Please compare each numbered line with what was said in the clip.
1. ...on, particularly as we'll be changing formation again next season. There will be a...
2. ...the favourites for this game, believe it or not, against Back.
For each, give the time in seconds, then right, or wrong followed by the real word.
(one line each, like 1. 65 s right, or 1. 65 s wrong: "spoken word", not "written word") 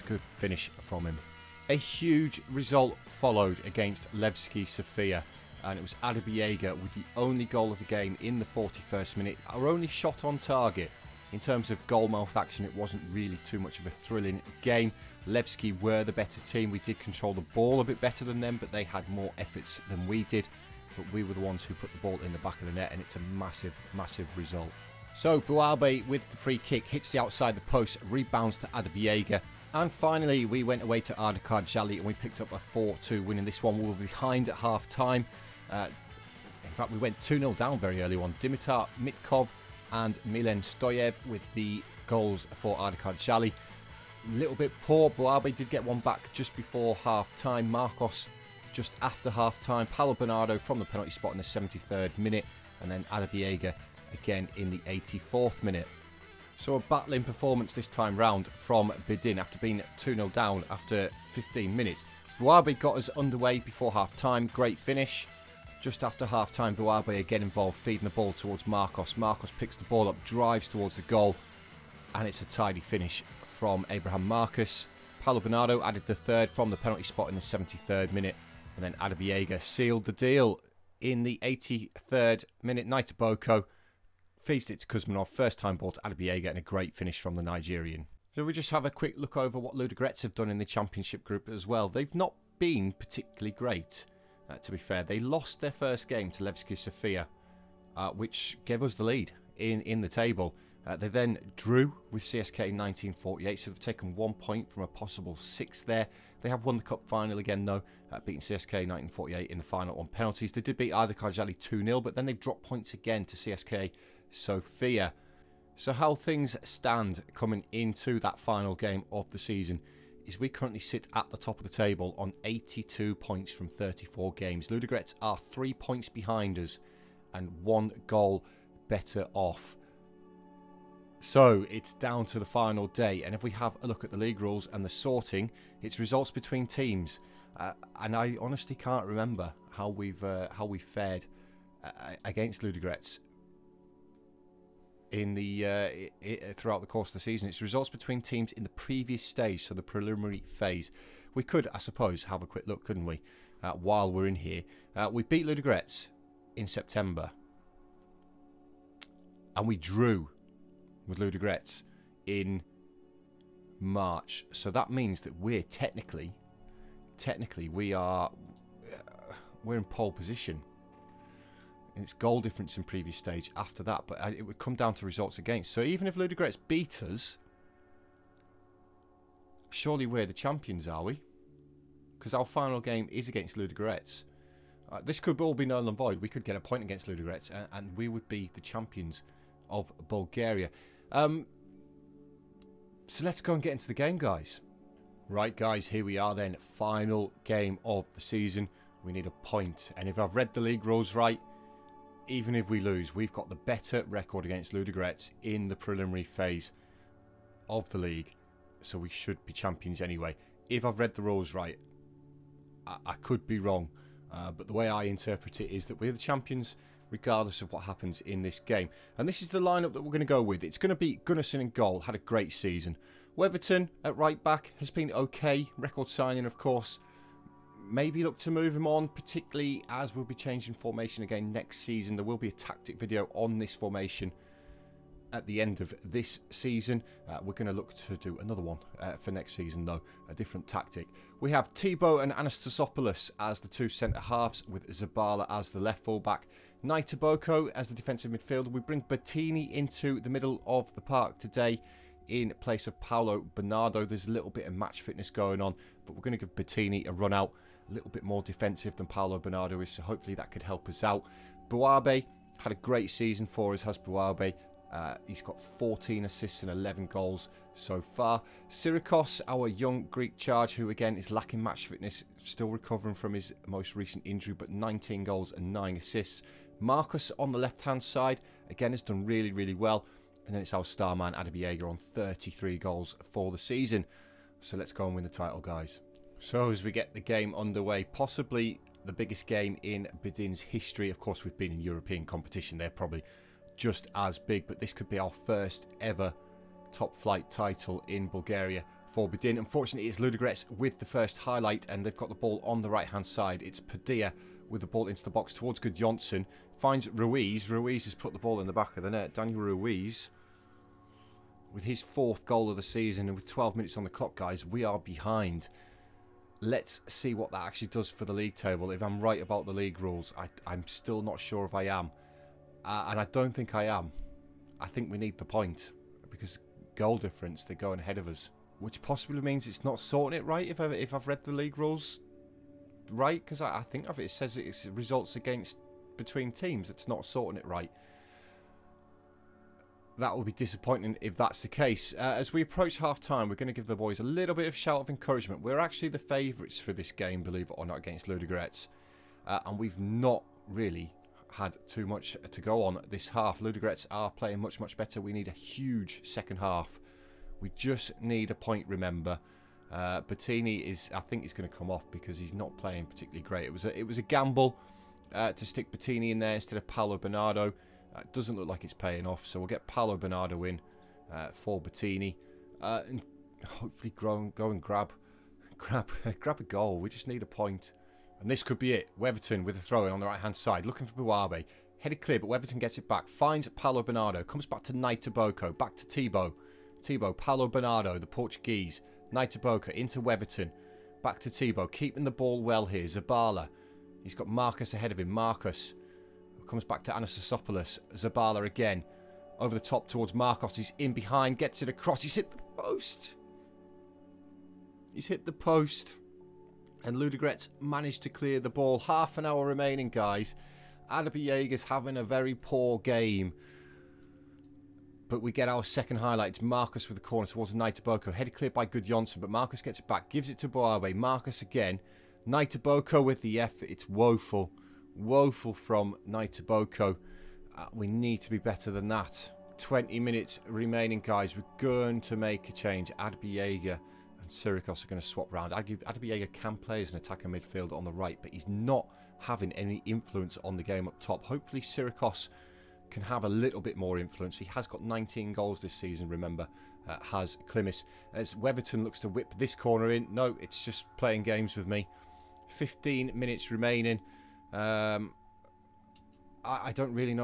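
1. 228 s right
2. 346 s wrong: "Ludogorets", not "Back".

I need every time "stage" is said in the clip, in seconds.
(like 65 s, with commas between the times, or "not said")
149 s, 173 s.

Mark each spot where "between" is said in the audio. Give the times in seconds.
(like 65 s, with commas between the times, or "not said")
136 s, 147 s, 336 s.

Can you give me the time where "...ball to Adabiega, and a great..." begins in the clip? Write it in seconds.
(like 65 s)
85 s.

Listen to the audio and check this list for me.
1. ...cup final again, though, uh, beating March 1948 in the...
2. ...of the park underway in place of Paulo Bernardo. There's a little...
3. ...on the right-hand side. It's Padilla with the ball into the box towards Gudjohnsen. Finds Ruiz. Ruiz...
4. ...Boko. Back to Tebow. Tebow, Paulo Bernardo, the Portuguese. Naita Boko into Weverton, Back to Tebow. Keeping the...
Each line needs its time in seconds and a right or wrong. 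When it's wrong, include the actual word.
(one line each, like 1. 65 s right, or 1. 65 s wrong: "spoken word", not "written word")
1. 106 s wrong: "CSK", not "March"
2. 250 s wrong: "today", not "underway"
3. 302 s right
4. 385 s right.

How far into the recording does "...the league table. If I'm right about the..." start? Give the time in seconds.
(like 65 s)
318 s.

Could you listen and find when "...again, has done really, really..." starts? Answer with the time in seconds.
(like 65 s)
278 s.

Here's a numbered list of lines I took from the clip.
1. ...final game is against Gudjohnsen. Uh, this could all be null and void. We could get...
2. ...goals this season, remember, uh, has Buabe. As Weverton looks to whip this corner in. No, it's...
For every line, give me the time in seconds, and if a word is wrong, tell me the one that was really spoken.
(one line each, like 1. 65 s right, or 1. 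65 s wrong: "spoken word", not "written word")
1. 182 s wrong: "Ludogorets", not "Gudjohnsen"
2. 445 s wrong: "Klimis", not "Buabe".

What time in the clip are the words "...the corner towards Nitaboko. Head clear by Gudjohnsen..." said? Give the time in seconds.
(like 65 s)
417 s.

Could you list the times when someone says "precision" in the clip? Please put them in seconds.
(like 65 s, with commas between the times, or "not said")
not said.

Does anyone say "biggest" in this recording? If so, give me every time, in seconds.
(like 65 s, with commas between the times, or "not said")
289 s.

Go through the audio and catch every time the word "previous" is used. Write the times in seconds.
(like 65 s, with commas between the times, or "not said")
148 s, 172 s.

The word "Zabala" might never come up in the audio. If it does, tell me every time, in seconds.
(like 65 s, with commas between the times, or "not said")
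244 s, 393 s, 398 s.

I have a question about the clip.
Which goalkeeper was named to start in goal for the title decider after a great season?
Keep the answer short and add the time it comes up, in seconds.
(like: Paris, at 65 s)
Gunnarsson, at 221 s.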